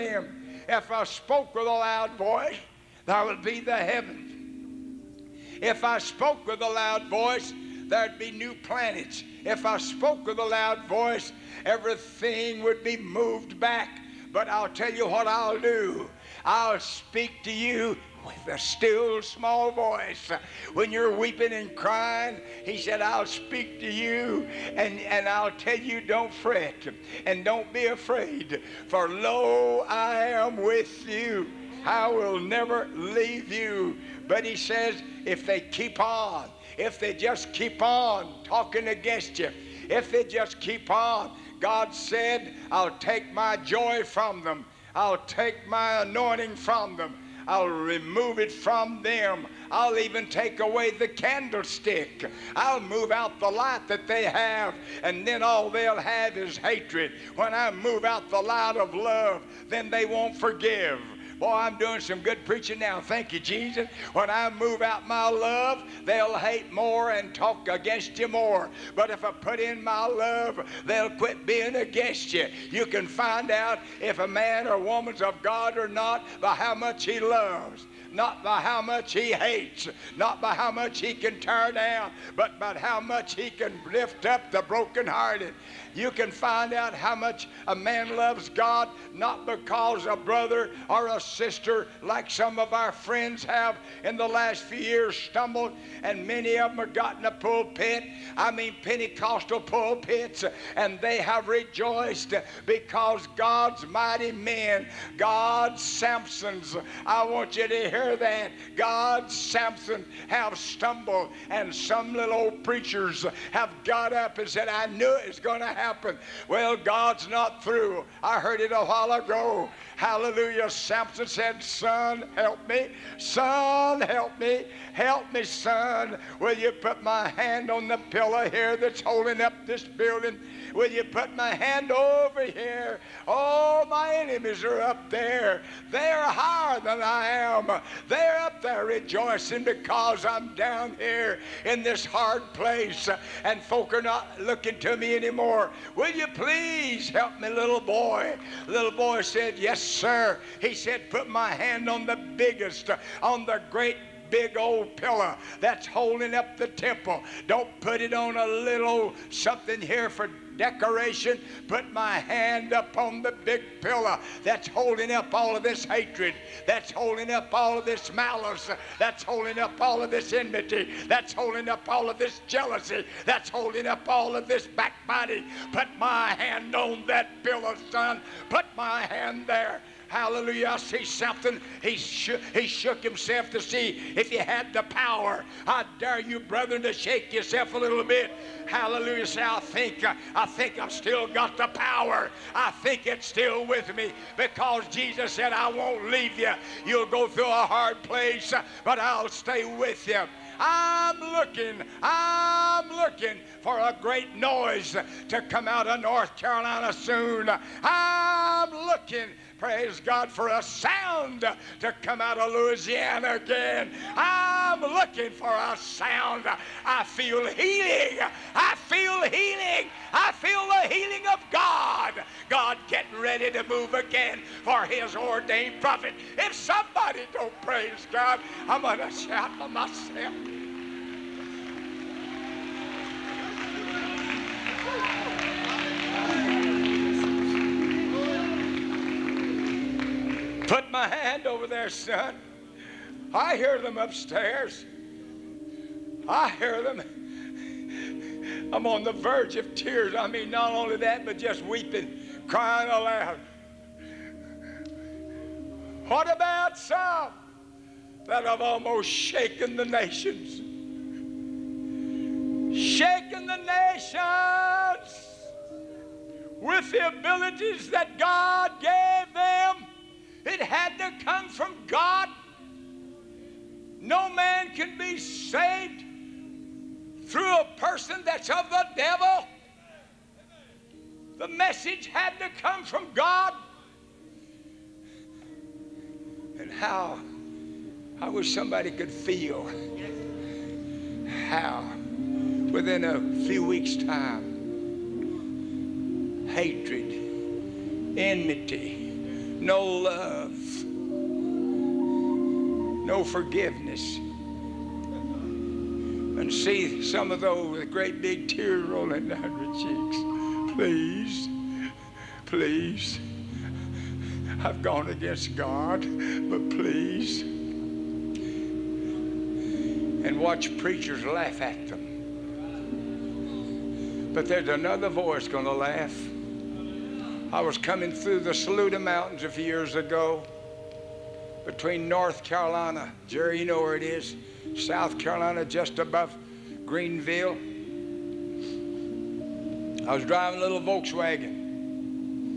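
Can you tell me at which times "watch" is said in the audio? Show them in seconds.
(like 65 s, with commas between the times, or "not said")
320 s.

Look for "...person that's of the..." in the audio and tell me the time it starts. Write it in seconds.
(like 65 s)
277 s.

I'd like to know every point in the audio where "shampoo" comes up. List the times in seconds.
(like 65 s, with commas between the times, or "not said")
not said.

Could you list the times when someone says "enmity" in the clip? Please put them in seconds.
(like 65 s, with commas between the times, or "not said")
170 s, 298 s.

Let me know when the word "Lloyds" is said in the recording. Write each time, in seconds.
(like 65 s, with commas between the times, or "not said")
not said.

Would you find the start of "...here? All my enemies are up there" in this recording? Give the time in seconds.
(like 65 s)
132 s.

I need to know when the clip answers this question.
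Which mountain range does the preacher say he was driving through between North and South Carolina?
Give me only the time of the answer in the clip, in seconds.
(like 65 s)
328 s.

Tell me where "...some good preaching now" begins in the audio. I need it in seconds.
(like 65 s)
61 s.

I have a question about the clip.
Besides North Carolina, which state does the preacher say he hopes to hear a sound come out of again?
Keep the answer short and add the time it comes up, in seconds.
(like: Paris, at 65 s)
Louisiana, at 212 s.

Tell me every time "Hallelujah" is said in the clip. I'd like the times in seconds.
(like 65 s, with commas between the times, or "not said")
119 s, 180 s, 188 s.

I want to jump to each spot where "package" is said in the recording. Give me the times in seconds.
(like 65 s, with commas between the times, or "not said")
not said.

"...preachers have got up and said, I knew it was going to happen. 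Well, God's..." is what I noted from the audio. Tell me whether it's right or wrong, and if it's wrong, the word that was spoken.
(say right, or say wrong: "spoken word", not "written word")
right.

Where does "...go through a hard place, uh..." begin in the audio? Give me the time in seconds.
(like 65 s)
197 s.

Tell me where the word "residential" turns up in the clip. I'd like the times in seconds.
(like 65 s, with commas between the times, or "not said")
not said.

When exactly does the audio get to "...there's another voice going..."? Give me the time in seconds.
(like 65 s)
324 s.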